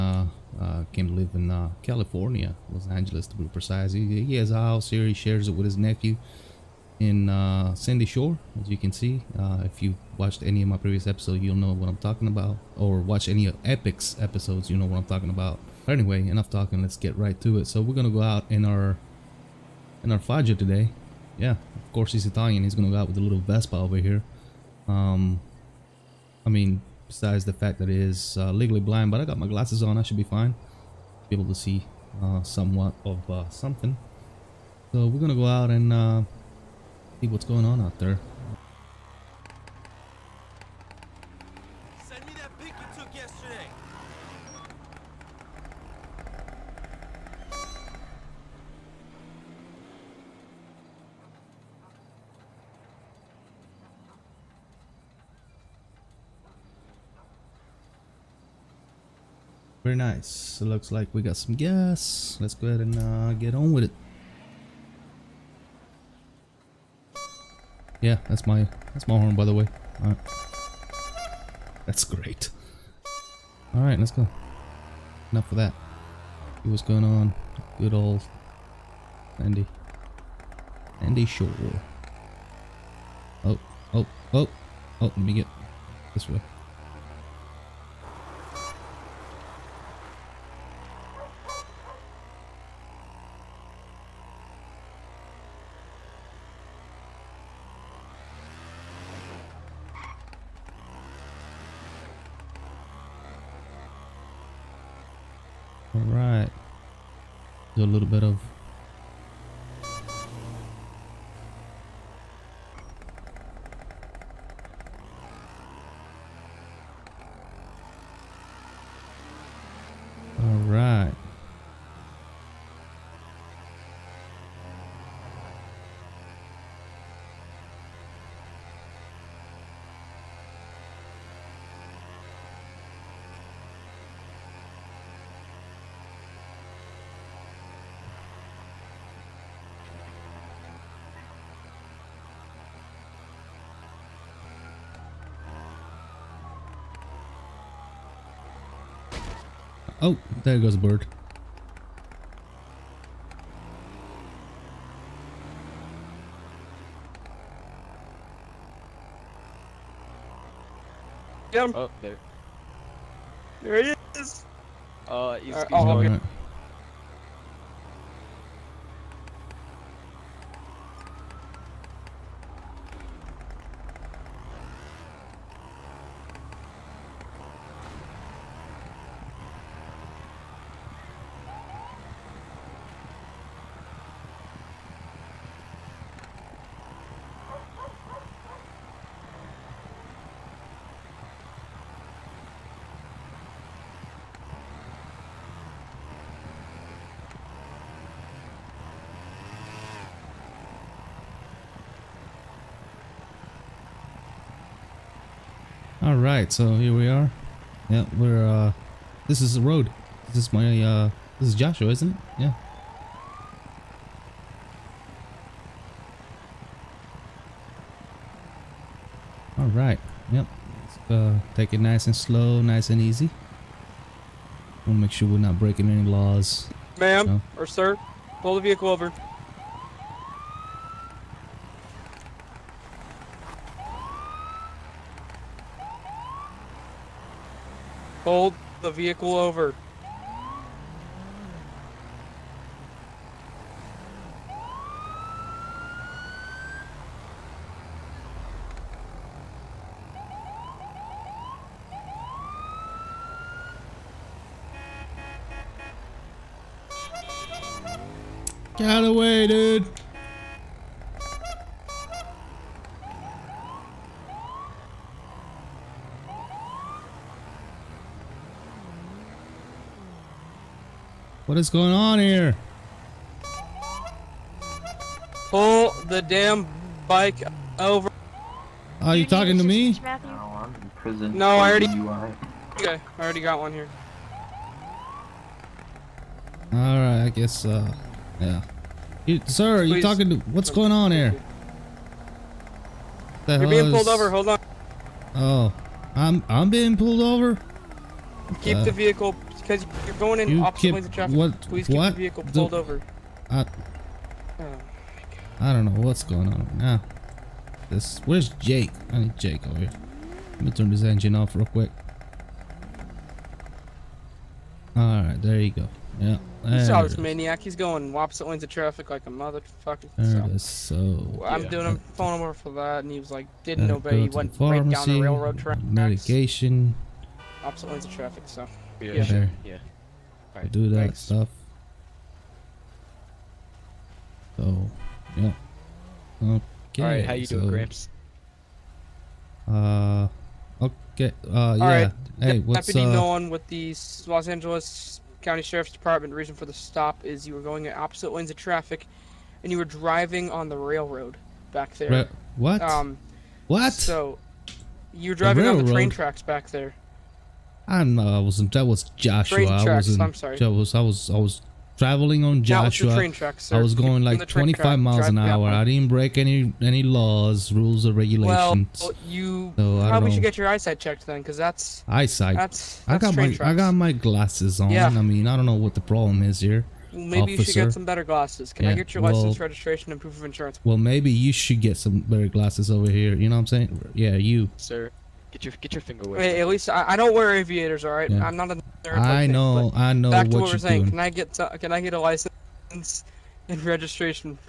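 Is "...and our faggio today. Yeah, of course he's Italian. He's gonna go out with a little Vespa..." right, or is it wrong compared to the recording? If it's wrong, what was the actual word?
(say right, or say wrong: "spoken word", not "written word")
right.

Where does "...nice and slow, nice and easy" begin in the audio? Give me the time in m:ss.
3:41.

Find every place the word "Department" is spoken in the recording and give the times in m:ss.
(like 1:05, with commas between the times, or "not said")
5:45.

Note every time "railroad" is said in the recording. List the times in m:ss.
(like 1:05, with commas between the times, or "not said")
5:25, 5:50.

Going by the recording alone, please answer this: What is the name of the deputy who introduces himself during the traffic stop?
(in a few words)
Nolan.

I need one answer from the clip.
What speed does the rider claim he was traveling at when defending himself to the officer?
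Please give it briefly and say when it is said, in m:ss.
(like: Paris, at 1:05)
25 miles an hour, at 6:04.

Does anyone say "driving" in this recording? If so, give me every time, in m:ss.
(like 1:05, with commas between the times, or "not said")
5:49, 5:55.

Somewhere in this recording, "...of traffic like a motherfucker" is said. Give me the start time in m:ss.
5:18.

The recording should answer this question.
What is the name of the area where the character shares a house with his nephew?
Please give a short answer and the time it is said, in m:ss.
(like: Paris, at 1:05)
Sandy Shore, at 0:07.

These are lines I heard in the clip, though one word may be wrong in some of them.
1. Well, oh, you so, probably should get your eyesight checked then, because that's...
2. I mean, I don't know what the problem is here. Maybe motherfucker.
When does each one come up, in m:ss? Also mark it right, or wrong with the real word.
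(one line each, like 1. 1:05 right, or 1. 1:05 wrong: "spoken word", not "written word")
1. 6:09 right
2. 6:15 wrong: "officer", not "motherfucker".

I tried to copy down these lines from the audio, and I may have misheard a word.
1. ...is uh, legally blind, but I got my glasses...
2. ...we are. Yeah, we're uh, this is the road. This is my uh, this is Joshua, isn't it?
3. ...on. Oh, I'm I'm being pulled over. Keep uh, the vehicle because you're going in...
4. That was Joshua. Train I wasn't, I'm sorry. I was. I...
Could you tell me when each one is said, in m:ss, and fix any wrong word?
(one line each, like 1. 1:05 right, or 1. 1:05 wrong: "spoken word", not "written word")
1. 0:27 right
2. 3:26 right
3. 4:54 right
4. 5:58 right.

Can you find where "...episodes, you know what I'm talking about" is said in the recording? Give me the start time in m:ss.
0:14.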